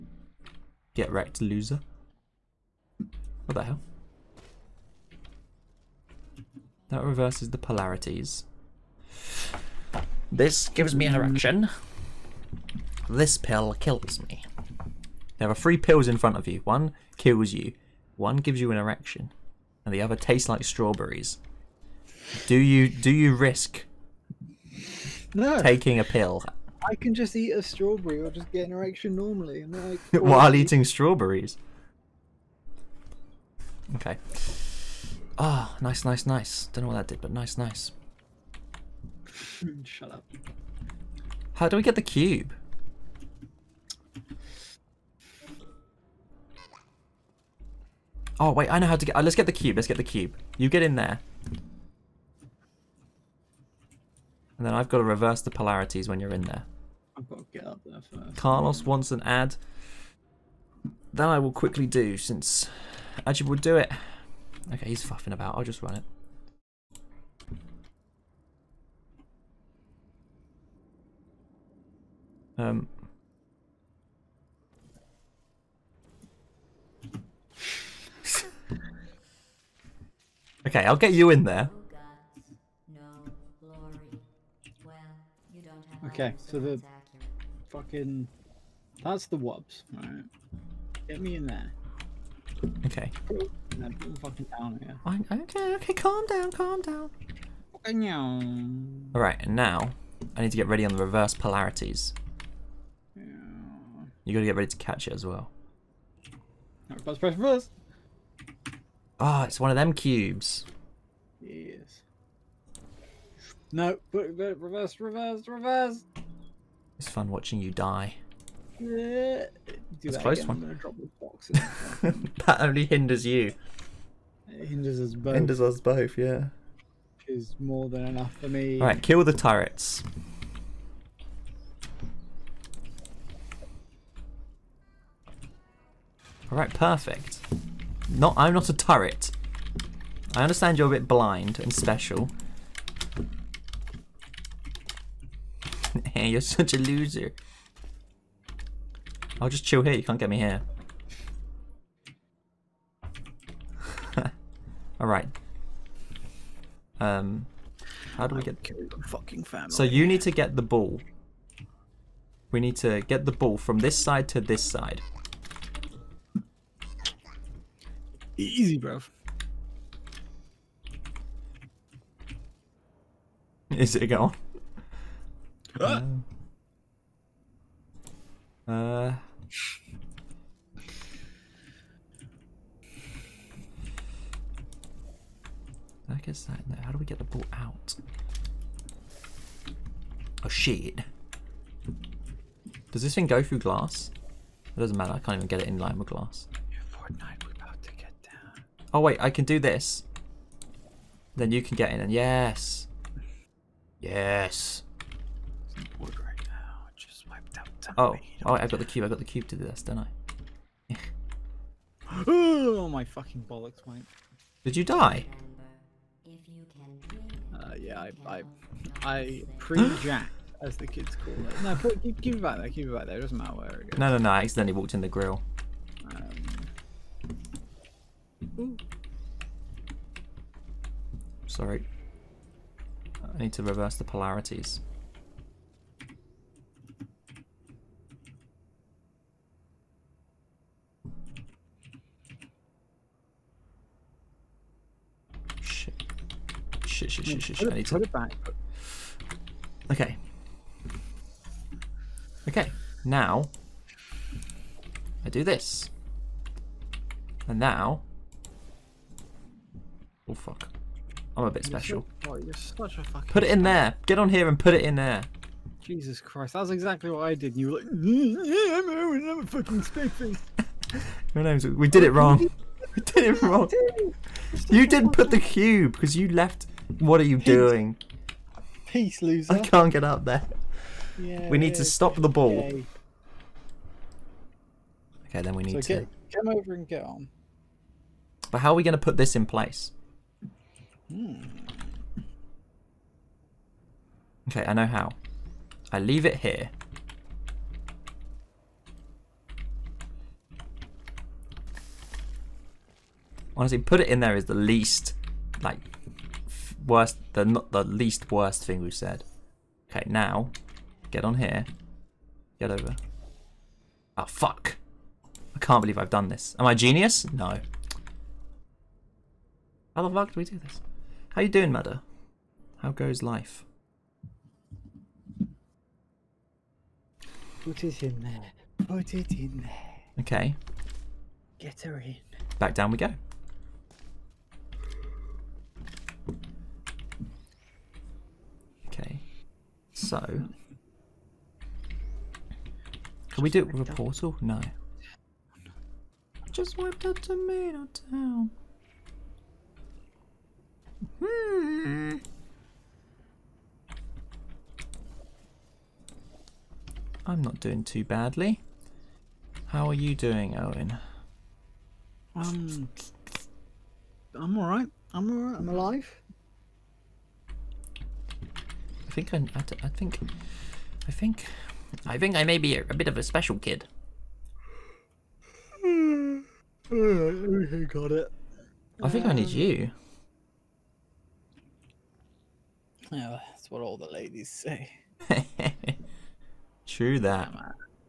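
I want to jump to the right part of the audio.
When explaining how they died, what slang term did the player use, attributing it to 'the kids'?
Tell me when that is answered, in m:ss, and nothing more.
3:39.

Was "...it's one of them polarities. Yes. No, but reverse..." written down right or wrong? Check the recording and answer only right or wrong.
wrong.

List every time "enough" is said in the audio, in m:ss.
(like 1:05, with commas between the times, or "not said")
2:08.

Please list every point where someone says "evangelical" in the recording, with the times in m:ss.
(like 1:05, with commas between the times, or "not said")
not said.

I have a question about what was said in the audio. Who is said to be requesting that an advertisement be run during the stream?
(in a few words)
Carlos.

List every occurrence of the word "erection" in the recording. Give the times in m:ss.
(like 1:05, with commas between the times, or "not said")
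0:11, 0:18, 0:28.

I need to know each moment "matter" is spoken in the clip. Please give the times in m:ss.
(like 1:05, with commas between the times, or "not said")
3:14, 3:43.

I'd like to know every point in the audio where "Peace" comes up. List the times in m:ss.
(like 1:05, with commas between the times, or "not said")
4:38.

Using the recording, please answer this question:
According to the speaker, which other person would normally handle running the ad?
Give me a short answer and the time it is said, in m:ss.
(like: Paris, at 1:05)
Ajib, at 1:03.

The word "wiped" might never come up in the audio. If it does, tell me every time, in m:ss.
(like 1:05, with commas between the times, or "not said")
3:27, 5:46.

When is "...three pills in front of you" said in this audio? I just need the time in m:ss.
0:15.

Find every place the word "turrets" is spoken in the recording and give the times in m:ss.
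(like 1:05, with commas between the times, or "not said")
2:09, 2:18.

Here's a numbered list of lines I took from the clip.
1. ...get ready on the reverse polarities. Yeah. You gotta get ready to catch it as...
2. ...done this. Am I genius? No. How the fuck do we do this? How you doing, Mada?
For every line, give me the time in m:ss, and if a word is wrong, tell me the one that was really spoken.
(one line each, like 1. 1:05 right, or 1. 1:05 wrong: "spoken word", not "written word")
1. 1:40 right
2. 5:16 right.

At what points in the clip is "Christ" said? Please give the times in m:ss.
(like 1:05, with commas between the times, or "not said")
4:26.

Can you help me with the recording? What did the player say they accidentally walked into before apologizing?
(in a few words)
the grill.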